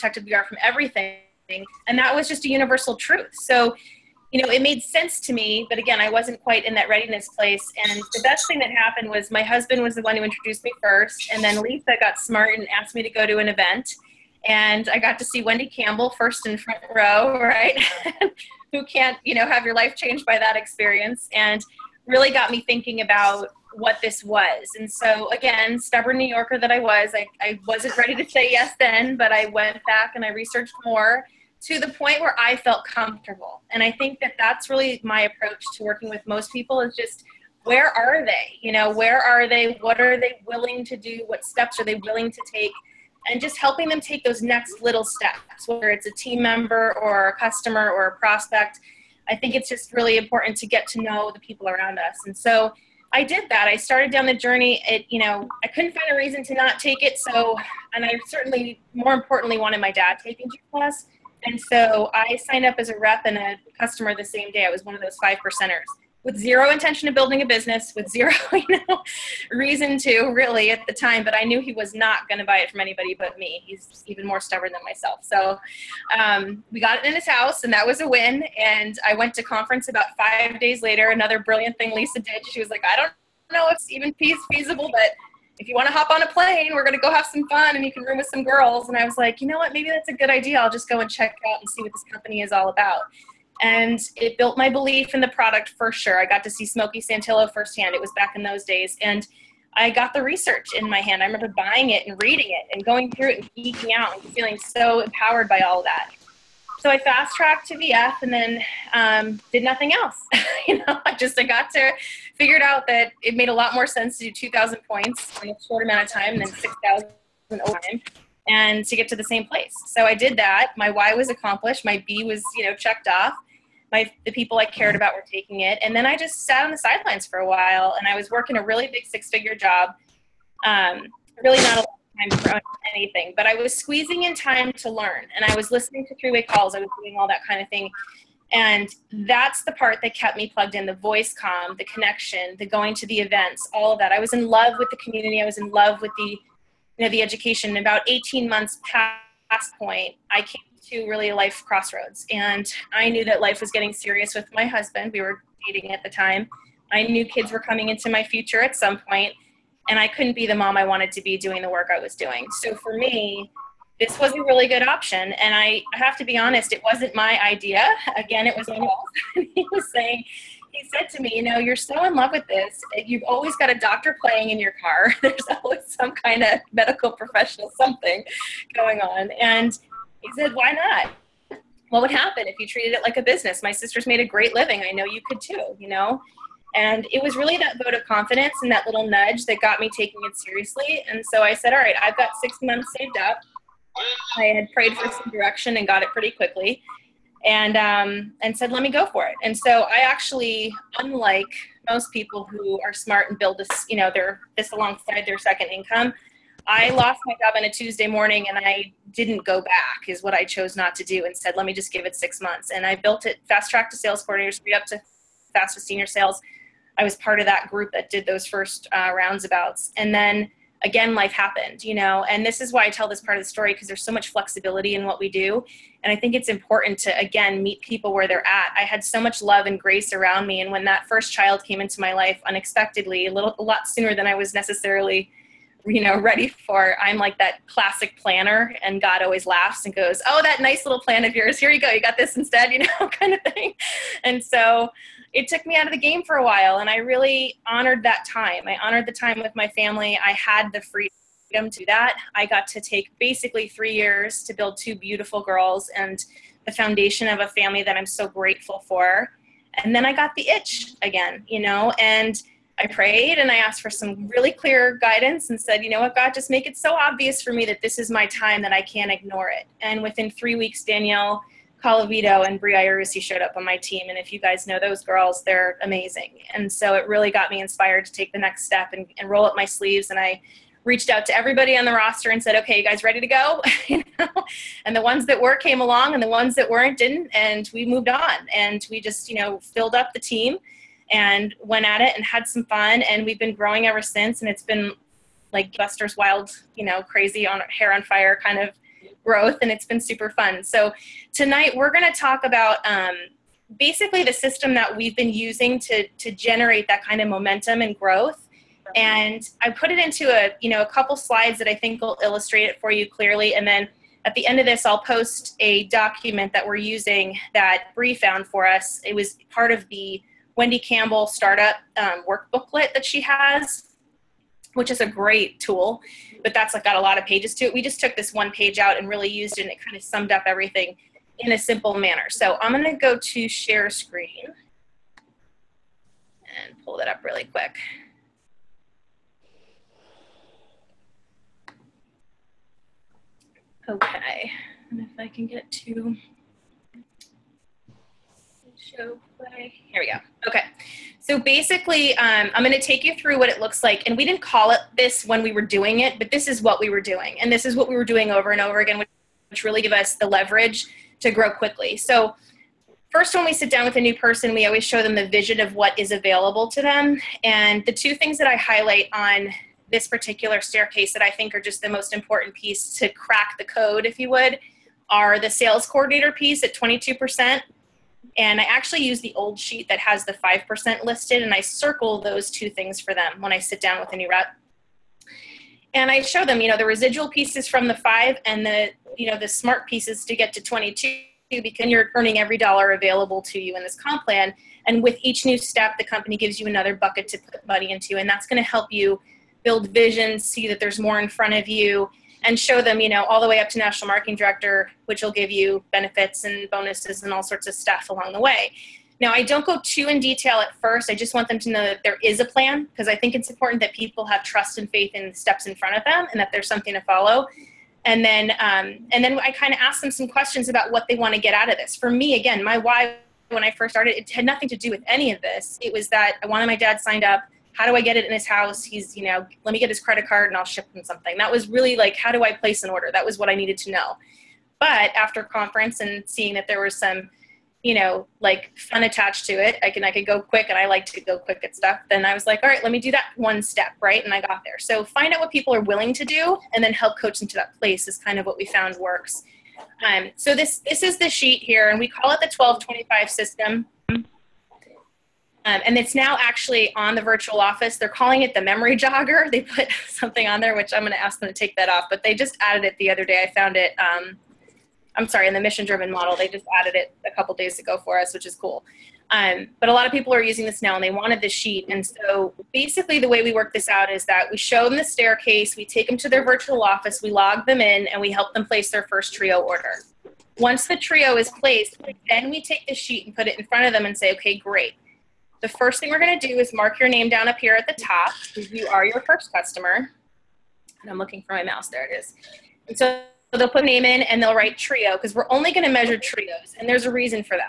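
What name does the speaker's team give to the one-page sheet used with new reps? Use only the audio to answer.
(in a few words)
1225 system.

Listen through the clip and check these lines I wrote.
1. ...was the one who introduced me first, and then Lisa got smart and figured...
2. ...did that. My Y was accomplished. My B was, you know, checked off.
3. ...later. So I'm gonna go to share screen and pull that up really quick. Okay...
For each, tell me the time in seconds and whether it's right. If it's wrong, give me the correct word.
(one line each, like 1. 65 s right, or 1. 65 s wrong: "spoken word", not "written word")
1. 9 s wrong: "asked", not "figured"
2. 120 s right
3. 331 s wrong: "manner", not "later".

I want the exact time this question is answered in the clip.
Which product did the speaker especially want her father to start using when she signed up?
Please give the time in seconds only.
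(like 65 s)
60 s.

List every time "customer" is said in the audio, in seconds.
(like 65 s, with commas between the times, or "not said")
47 s, 63 s, 489 s.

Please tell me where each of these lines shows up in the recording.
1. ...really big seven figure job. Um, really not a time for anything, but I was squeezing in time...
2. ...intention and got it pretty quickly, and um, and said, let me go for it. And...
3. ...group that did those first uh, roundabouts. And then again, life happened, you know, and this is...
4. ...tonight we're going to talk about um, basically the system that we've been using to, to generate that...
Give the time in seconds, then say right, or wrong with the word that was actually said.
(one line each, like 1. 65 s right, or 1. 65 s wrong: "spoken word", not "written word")
1. 128 s wrong: "six", not "seven"
2. 195 s wrong: "direction", not "intention"
3. 217 s right
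4. 301 s right.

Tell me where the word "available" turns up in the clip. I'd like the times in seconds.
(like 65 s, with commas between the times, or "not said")
366 s, 392 s.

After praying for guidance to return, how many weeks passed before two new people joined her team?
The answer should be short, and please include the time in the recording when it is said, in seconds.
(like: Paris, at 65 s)
3, at 270 s.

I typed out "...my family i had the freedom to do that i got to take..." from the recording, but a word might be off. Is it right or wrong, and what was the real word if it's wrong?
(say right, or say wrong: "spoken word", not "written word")
right.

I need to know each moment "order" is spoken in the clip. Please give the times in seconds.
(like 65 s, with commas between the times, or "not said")
432 s, 479 s.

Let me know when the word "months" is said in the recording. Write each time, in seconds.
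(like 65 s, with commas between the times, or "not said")
148 s, 192 s, 212 s.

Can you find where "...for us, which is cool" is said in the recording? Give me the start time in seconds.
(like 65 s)
468 s.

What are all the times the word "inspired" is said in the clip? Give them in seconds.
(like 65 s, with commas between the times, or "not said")
277 s.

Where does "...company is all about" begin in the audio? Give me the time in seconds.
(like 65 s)
92 s.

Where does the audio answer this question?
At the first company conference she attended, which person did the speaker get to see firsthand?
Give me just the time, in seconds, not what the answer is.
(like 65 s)
96 s.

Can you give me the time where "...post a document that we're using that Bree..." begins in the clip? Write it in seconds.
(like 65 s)
314 s.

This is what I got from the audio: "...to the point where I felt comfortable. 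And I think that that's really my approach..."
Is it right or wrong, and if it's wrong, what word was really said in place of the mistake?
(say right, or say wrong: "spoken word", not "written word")
right.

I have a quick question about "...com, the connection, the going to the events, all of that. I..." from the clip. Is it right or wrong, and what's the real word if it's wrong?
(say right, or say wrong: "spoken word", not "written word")
right.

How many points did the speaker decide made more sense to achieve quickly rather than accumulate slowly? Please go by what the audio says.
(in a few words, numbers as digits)
2,000.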